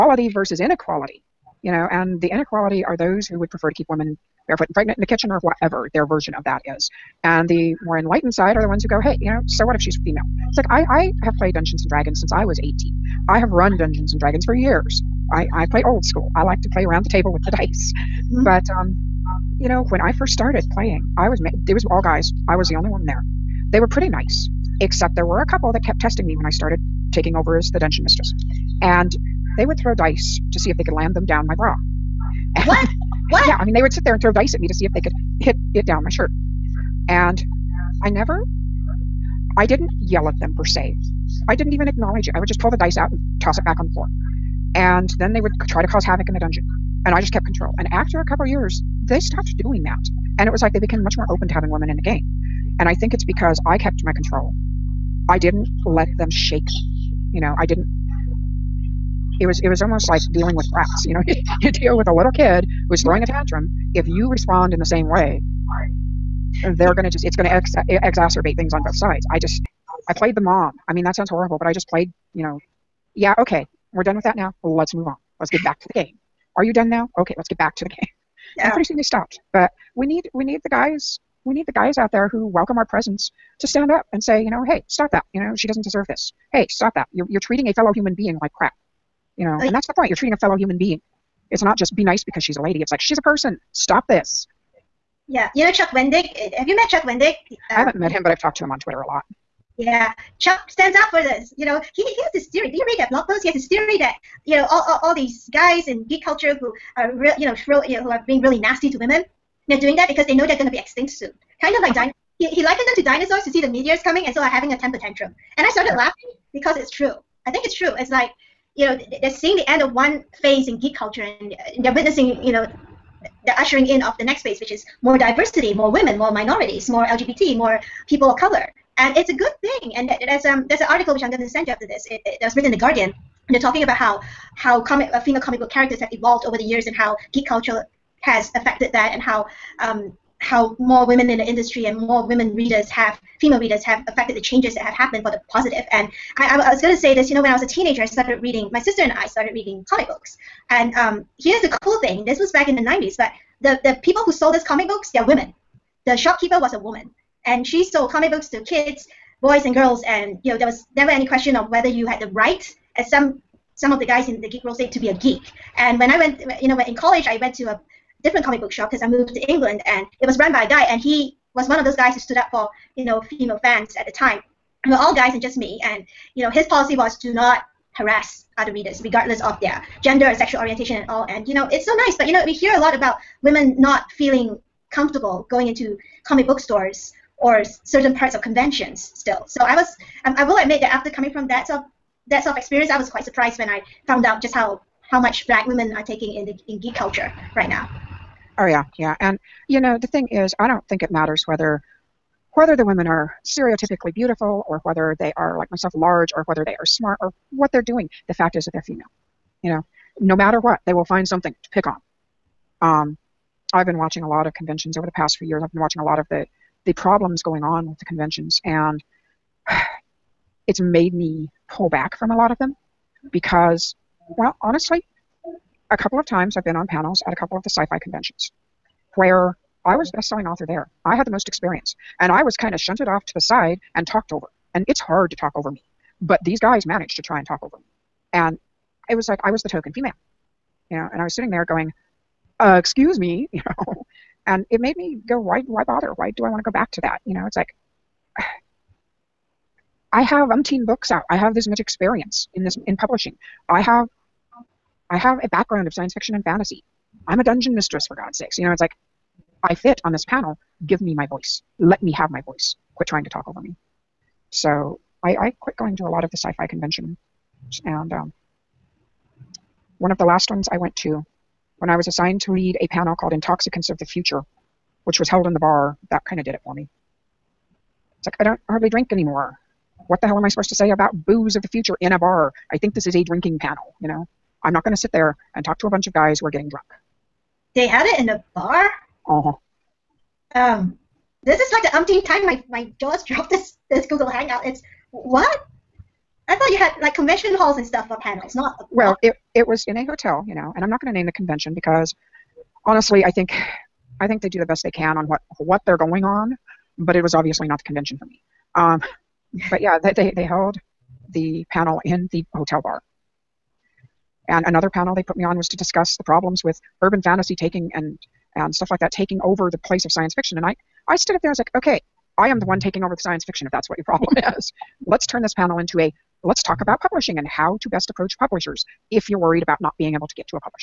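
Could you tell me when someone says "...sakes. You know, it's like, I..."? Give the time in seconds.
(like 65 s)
258 s.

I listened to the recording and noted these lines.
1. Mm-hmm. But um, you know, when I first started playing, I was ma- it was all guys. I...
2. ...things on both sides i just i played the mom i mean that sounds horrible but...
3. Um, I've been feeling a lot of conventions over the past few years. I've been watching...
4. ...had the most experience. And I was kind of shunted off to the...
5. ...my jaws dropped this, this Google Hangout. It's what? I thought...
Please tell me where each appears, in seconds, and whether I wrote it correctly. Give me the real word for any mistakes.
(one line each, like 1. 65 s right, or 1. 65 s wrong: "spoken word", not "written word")
1. 18 s right
2. 68 s right
3. 212 s wrong: "watching", not "feeling"
4. 231 s right
5. 292 s right.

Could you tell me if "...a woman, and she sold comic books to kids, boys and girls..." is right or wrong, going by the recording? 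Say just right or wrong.
right.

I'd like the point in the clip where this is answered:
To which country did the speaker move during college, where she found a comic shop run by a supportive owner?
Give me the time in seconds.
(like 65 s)
169 s.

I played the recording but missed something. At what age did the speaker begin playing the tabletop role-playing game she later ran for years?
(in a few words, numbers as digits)
18.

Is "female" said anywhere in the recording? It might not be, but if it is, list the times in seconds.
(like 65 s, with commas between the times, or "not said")
10 s, 135 s, 143 s, 173 s, 208 s, 239 s.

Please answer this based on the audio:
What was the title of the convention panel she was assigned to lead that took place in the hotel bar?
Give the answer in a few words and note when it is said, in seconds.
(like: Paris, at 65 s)
Intoxicants of the Future, at 273 s.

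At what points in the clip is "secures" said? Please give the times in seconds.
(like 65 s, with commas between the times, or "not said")
not said.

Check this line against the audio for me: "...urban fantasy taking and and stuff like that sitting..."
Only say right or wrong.
wrong.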